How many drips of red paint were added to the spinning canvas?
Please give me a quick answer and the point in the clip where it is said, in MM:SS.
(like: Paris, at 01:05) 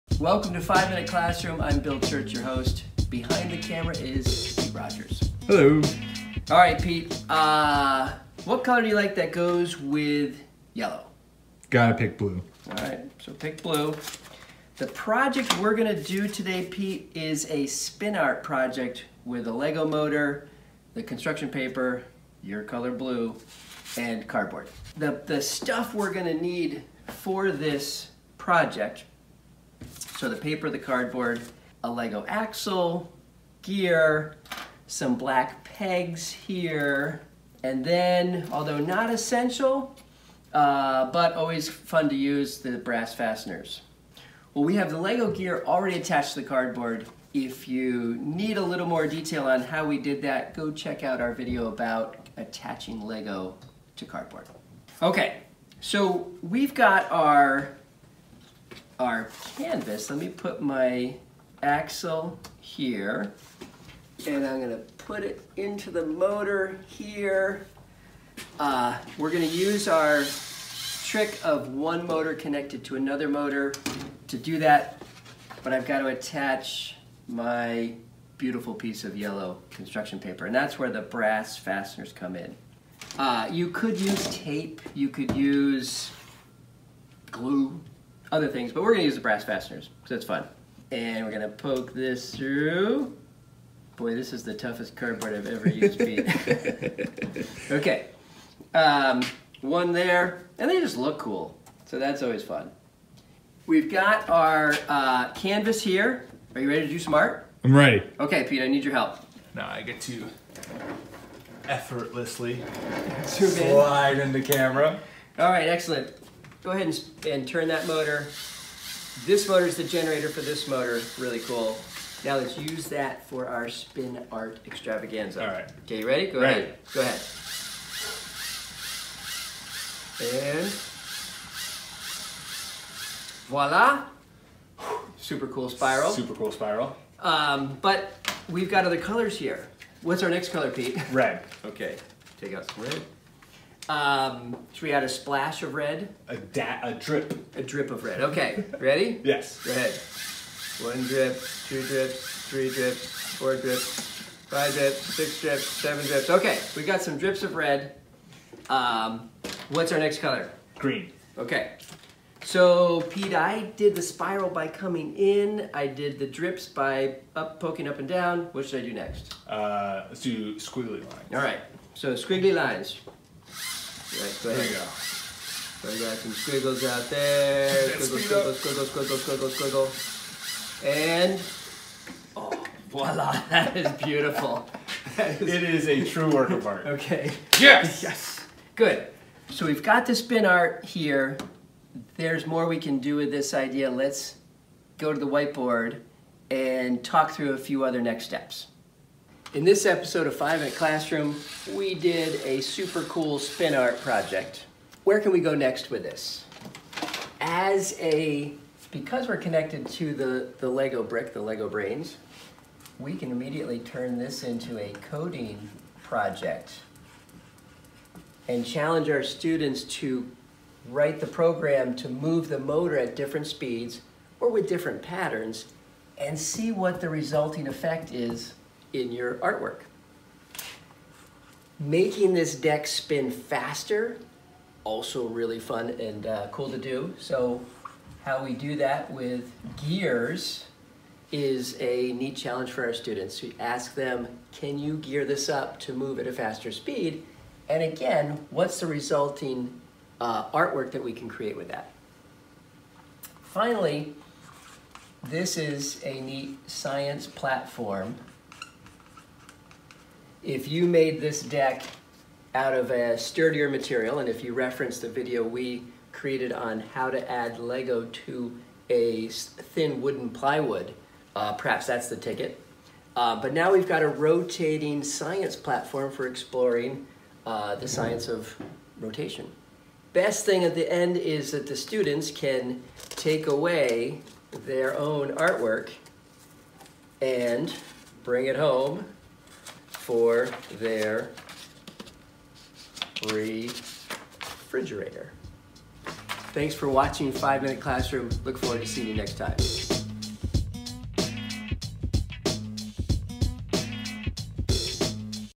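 7, at 02:35.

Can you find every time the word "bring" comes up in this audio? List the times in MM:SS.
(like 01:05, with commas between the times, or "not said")
04:48.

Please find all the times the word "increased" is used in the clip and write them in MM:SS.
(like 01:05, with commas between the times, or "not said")
not said.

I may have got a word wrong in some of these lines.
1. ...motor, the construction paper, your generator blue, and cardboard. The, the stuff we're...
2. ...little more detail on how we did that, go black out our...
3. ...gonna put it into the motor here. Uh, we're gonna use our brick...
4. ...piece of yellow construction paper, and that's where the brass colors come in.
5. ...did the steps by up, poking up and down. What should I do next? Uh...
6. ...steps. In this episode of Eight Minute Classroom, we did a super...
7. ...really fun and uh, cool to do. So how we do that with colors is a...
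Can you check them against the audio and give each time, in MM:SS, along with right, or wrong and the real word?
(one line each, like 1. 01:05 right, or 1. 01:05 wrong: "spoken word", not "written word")
1. 00:19 wrong: "color", not "generator"
2. 00:48 wrong: "check", not "black"
3. 01:04 wrong: "trick", not "brick"
4. 01:18 wrong: "fasteners", not "colors"
5. 02:45 wrong: "drips", not "steps"
6. 03:18 wrong: "Five", not "Eight"
7. 03:55 wrong: "gears", not "colors".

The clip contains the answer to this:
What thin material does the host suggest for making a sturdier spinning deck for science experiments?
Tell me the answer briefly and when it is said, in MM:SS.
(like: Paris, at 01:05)
Wooden plywood, at 04:30.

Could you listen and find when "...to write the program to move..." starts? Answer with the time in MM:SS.
03:39.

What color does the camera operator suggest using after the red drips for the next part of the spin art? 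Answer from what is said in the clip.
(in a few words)
Green.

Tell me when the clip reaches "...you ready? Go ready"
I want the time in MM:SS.
02:05.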